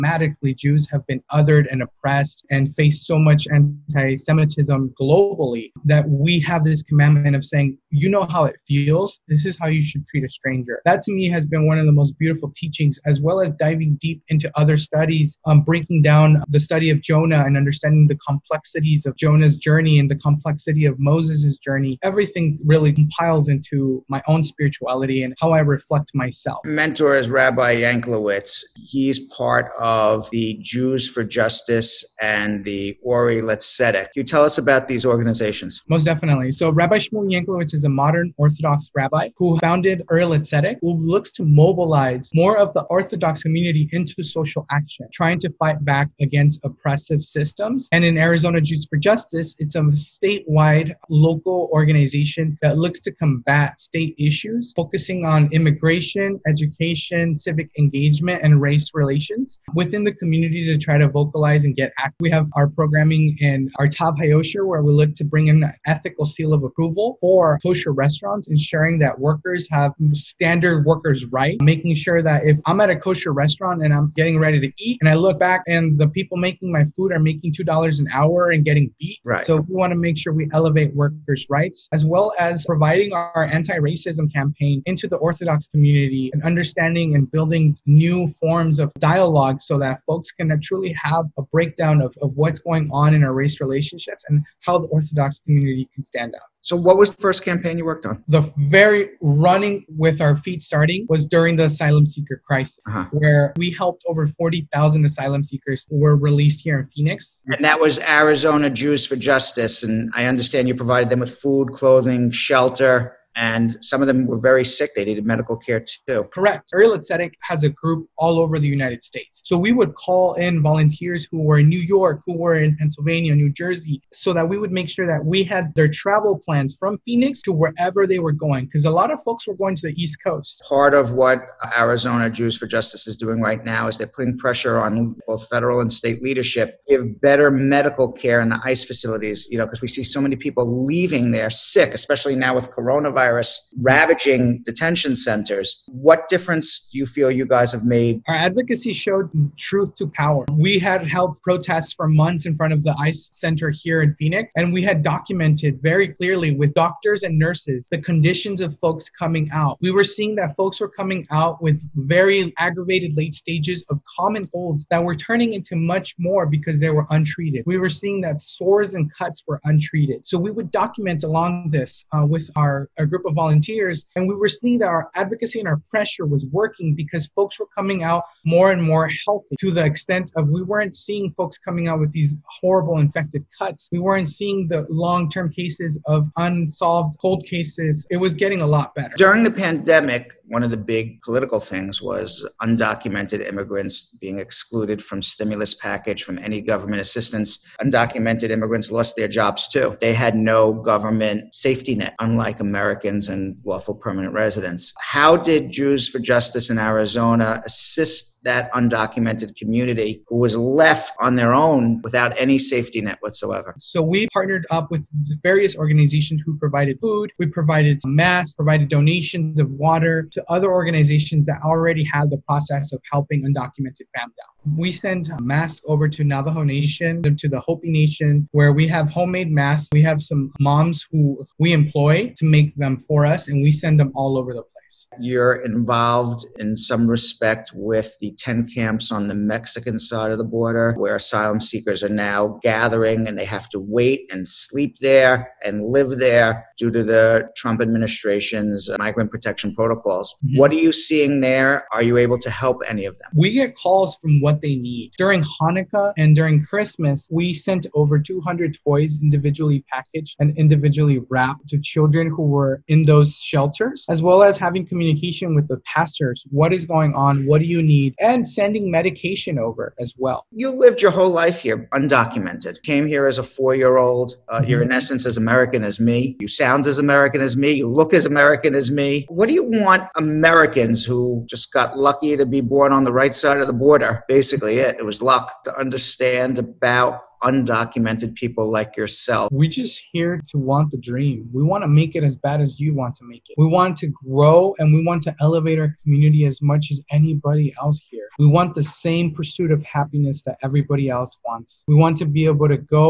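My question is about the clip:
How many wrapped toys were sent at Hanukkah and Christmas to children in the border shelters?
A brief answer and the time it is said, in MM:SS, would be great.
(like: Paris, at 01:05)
200, at 04:18.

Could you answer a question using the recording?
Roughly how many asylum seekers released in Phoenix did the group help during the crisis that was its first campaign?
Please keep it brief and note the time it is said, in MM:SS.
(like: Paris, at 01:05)
40,000, at 01:44.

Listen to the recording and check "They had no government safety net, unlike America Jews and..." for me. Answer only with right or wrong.
wrong.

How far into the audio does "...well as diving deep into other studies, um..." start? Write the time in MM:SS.
00:13.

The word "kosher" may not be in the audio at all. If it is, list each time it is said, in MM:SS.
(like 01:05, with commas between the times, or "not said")
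01:07, 01:12.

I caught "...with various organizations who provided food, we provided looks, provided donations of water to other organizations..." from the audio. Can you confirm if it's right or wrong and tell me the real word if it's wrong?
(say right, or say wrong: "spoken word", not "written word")
wrong: "masks", not "looks".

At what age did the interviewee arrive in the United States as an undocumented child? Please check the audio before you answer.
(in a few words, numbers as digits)
4.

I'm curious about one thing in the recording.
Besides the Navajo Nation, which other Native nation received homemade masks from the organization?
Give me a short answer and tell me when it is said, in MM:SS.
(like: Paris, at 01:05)
Hopi Nation, at 03:47.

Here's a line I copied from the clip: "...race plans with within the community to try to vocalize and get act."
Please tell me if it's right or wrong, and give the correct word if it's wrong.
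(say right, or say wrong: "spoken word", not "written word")
wrong: "relations", not "plans".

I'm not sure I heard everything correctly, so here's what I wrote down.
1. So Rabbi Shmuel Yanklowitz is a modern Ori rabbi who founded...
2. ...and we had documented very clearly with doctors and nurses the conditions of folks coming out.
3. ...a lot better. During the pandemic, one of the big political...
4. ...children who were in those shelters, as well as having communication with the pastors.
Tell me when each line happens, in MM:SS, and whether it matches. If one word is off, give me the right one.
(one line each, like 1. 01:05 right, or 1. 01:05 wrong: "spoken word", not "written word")
1. 00:36 wrong: "Orthodox", not "Ori"
2. 02:34 right
3. 03:08 right
4. 04:21 right.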